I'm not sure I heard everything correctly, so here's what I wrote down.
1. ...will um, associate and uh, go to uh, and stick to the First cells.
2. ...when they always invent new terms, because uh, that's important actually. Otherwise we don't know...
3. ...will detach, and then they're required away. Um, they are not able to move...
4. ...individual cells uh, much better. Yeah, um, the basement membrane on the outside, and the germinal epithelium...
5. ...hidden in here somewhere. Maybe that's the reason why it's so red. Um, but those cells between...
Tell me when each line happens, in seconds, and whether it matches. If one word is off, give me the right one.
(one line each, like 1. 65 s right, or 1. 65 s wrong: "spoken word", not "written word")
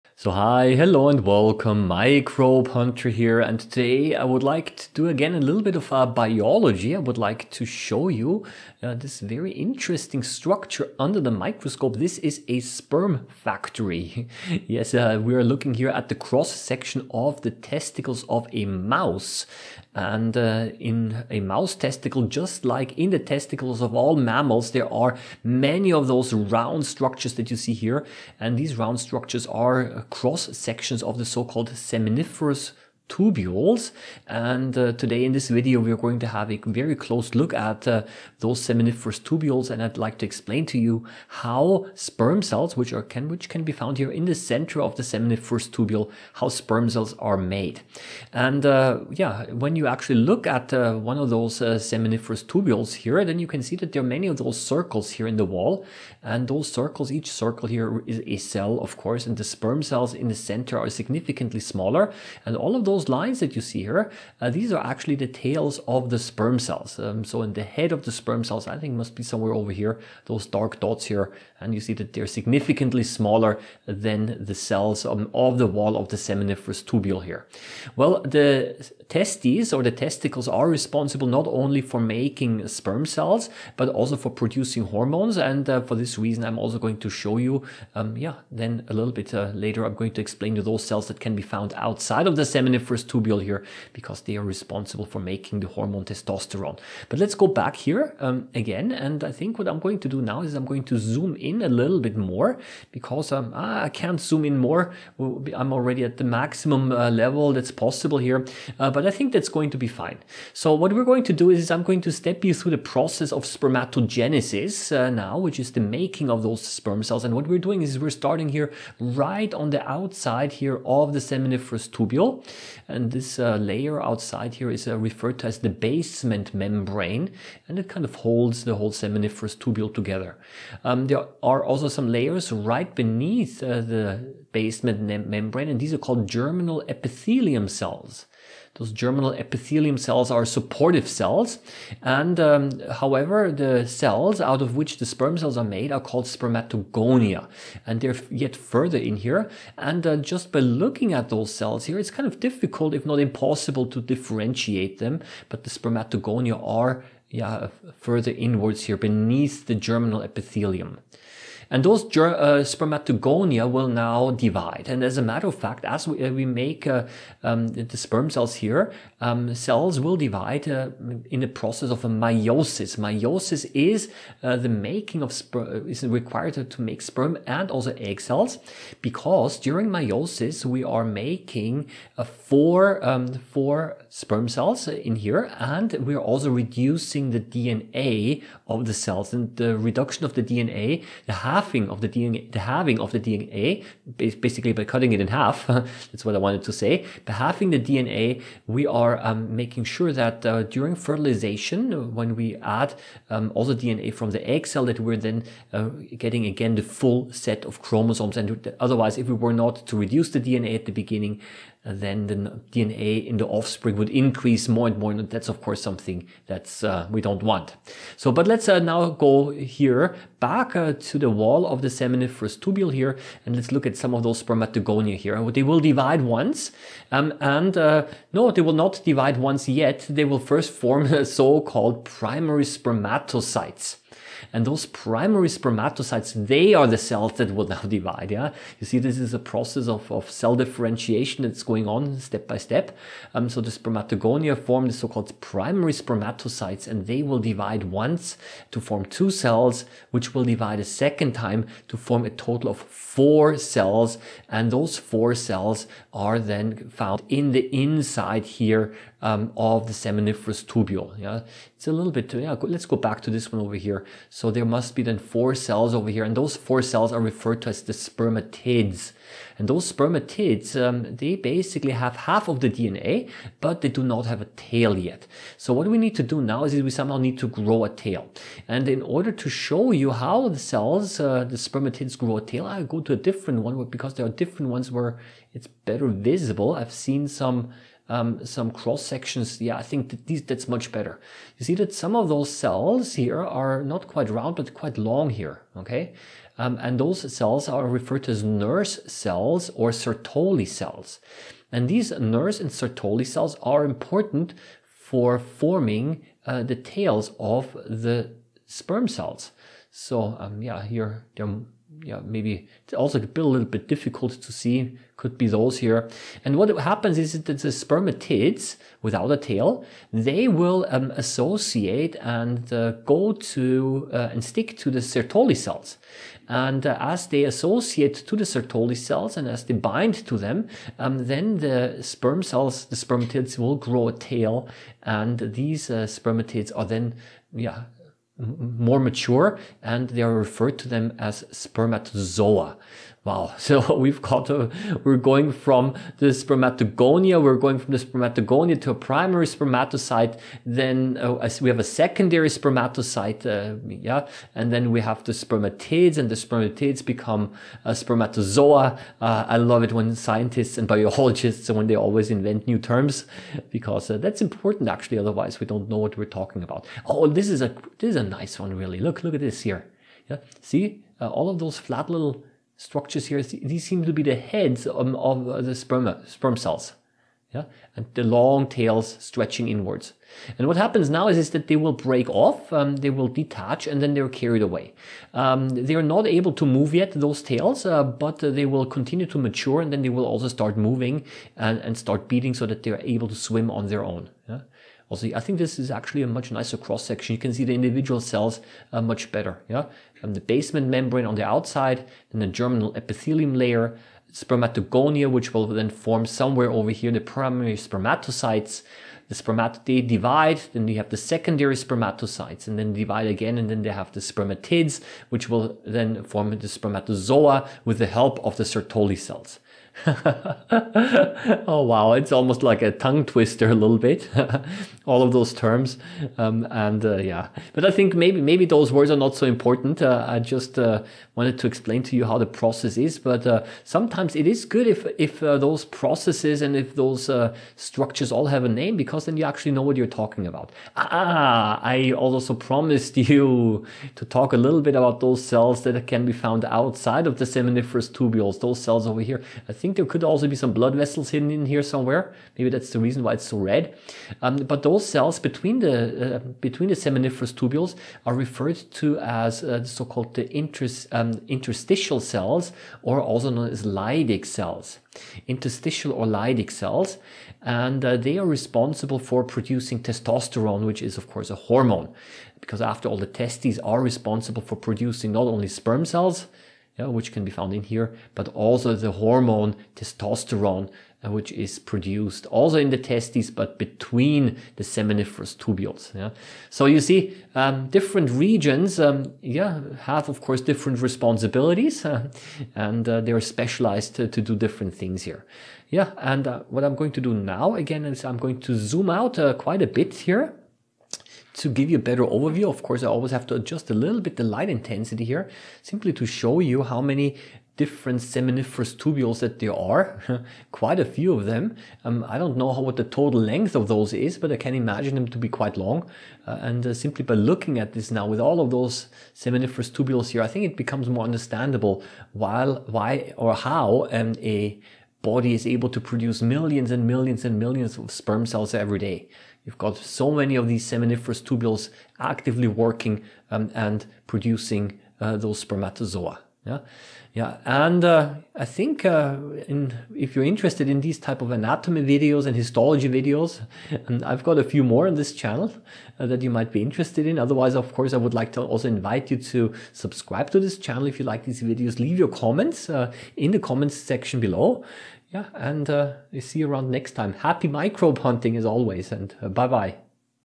1. 320 s wrong: "Sertoli", not "First"
2. 361 s right
3. 383 s wrong: "carried", not "required"
4. 397 s right
5. 451 s right.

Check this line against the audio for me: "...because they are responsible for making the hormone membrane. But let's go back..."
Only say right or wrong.
wrong.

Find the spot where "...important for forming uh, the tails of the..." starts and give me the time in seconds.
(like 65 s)
303 s.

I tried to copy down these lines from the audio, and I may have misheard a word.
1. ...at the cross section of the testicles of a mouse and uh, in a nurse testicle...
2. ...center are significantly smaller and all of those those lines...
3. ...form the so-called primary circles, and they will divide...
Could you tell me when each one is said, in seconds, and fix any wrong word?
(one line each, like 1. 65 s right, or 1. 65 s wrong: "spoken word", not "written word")
1. 15 s wrong: "mouse", not "nurse"
2. 60 s right
3. 244 s wrong: "spermatocytes", not "circles".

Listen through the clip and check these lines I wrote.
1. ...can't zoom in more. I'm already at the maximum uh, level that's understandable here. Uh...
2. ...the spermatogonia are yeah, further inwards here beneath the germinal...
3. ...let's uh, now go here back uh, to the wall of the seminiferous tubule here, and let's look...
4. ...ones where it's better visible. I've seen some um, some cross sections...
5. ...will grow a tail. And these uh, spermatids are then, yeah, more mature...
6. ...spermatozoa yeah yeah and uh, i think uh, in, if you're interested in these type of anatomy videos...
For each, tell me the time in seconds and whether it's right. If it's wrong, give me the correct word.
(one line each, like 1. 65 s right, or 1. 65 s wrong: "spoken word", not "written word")
1. 103 s wrong: "possible", not "understandable"
2. 155 s right
3. 218 s right
4. 284 s right
5. 333 s right
6. 535 s right.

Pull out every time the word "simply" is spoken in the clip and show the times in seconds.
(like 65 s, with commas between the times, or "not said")
505 s, 516 s.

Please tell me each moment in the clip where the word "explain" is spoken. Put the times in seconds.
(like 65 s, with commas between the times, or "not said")
40 s, 90 s, 431 s.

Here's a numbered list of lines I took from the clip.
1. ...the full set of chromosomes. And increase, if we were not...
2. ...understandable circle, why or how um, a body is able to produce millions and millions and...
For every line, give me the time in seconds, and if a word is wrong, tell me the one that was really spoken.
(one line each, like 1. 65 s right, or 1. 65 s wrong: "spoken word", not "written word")
1. 206 s wrong: "otherwise", not "increase"
2. 521 s wrong: "while", not "circle".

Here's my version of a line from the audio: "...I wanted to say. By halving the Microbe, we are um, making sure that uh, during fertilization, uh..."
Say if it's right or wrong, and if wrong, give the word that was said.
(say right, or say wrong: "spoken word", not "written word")
wrong: "DNA", not "Microbe".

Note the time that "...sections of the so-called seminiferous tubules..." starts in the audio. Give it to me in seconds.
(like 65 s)
30 s.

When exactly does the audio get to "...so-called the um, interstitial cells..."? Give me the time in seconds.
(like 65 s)
459 s.